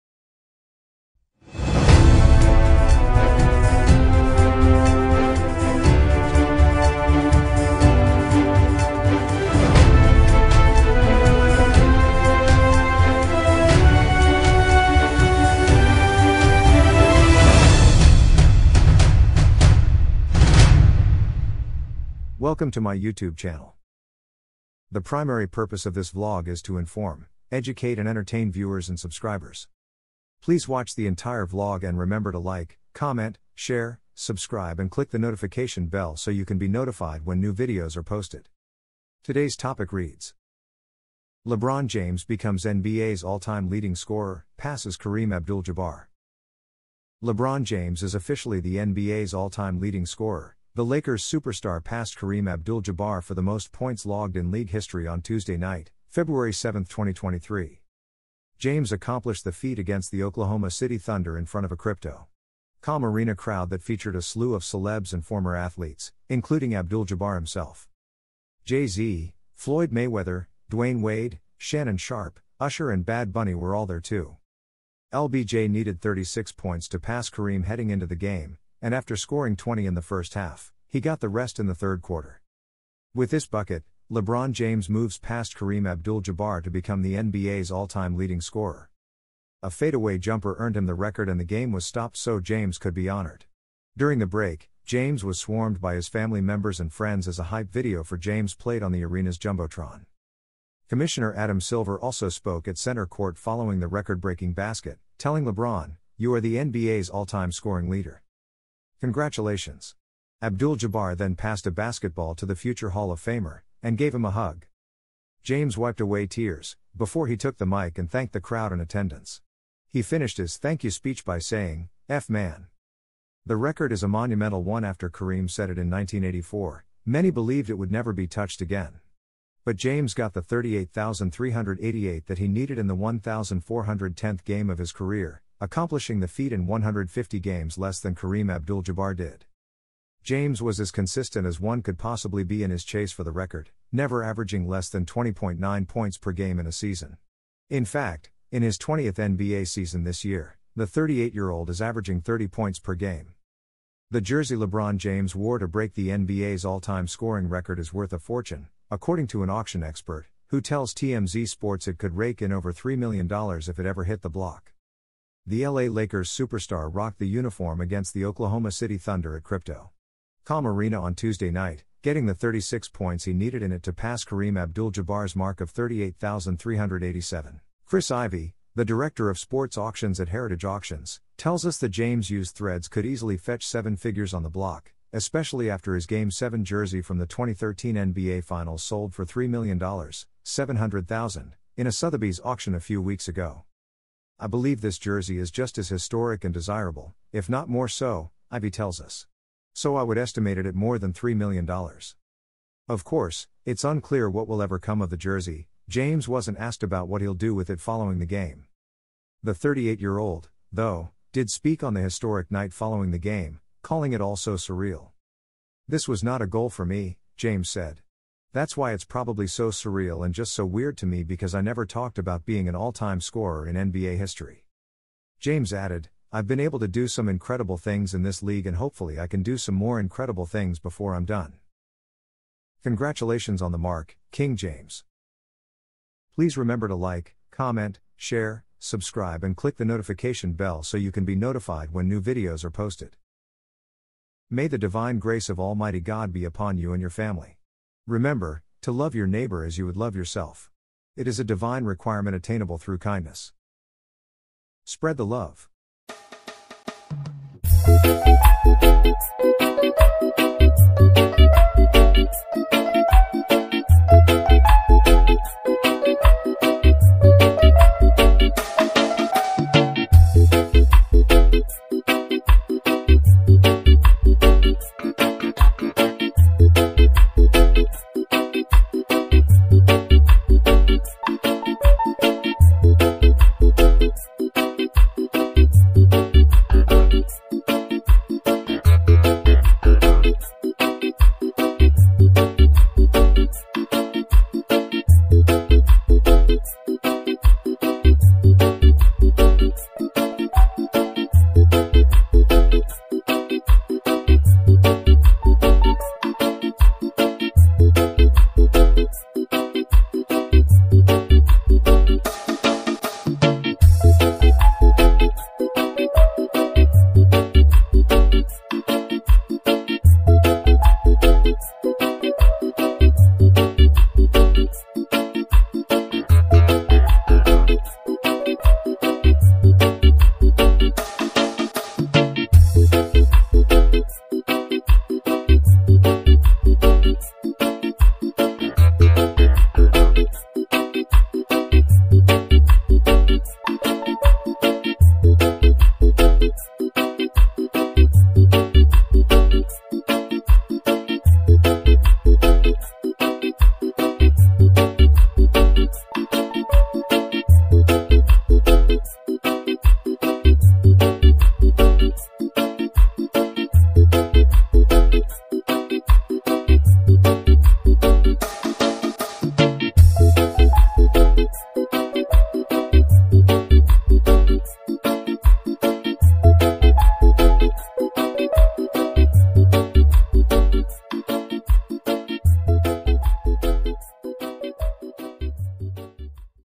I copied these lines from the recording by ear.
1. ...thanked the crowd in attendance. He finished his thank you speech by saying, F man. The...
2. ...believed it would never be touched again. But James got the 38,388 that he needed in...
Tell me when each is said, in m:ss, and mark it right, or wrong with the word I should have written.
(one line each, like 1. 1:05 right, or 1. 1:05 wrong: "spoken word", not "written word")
1. 1:58 right
2. 2:07 right.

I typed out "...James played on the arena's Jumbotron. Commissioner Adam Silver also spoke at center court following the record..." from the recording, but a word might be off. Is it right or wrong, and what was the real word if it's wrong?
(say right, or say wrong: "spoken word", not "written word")
right.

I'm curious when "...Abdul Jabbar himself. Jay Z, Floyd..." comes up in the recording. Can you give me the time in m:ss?
1:06.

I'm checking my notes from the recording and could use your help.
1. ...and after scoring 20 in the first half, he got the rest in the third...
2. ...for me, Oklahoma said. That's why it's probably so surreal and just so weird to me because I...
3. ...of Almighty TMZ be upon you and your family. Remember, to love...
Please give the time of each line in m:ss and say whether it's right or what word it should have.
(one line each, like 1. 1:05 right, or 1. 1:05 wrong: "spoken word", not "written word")
1. 1:18 right
2. 3:36 wrong: "James", not "Oklahoma"
3. 4:05 wrong: "God", not "TMZ".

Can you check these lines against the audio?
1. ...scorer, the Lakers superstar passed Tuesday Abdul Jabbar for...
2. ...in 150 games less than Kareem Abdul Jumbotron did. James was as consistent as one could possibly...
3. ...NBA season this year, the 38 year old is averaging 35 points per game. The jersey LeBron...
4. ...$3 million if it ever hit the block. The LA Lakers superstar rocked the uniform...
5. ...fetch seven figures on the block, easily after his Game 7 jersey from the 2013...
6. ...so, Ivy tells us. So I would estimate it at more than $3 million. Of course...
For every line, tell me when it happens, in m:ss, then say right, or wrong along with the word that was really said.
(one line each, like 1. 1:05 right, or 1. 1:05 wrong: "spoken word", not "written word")
1. 0:50 wrong: "Kareem", not "Tuesday"
2. 2:16 wrong: "Jabbar", not "Jumbotron"
3. 2:29 wrong: "30", not "35"
4. 2:42 right
5. 3:03 wrong: "especially", not "easily"
6. 3:17 right.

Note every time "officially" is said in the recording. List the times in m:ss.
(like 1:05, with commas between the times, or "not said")
0:48.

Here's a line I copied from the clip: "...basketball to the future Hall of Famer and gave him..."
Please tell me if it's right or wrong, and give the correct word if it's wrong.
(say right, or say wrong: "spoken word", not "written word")
right.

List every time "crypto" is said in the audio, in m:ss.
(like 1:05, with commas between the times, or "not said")
1:01, 2:49.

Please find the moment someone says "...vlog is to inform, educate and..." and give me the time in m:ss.
0:26.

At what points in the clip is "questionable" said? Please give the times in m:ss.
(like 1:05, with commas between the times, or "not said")
not said.